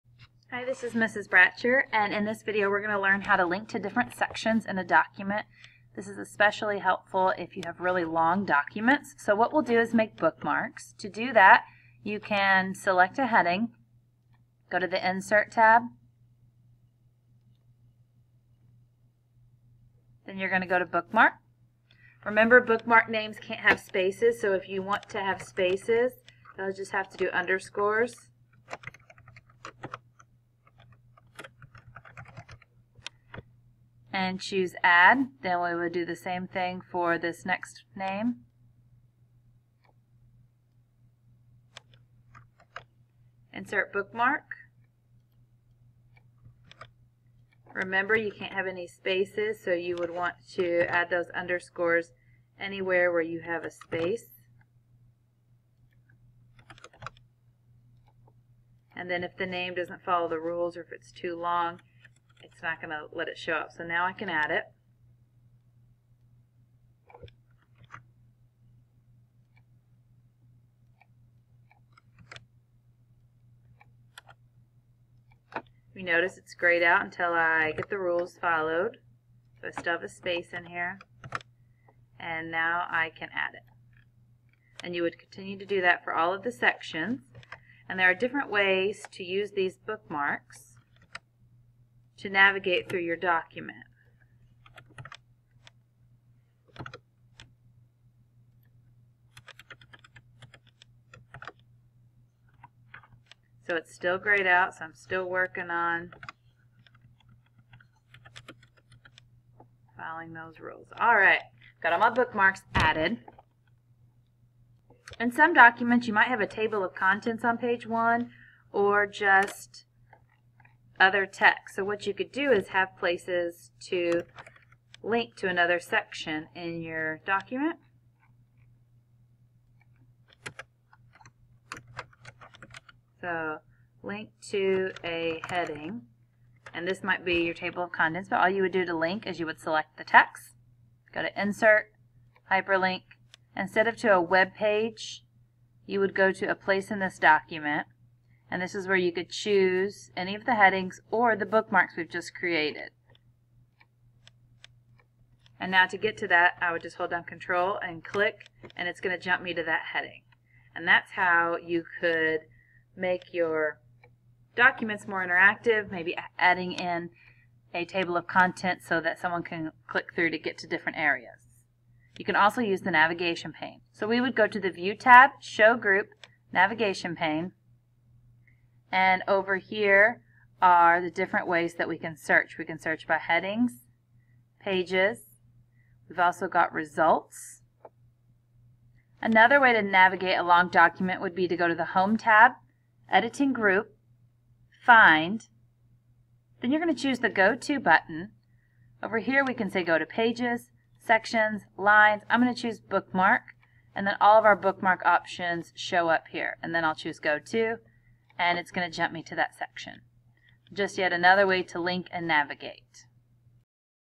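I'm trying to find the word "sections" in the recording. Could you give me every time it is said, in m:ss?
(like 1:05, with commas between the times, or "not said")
0:04, 1:26, 2:05, 3:20, 3:29.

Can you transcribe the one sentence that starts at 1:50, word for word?
All right, got all my bookmarks added.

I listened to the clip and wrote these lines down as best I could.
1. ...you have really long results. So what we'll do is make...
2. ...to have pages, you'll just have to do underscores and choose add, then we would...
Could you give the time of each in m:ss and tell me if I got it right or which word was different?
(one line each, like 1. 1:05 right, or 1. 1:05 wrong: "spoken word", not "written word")
1. 0:07 wrong: "documents", not "results"
2. 0:25 wrong: "spaces", not "pages".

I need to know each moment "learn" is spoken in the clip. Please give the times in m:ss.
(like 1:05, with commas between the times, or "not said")
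0:02.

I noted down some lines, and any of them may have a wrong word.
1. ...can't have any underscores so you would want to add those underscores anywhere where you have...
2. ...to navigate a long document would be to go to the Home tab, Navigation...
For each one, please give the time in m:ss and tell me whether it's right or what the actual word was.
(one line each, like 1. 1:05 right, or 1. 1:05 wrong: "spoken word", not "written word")
1. 0:48 wrong: "spaces", not "underscores"
2. 3:09 wrong: "Editing", not "Navigation".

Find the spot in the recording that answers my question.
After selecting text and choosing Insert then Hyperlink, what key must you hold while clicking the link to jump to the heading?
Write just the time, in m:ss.
2:37.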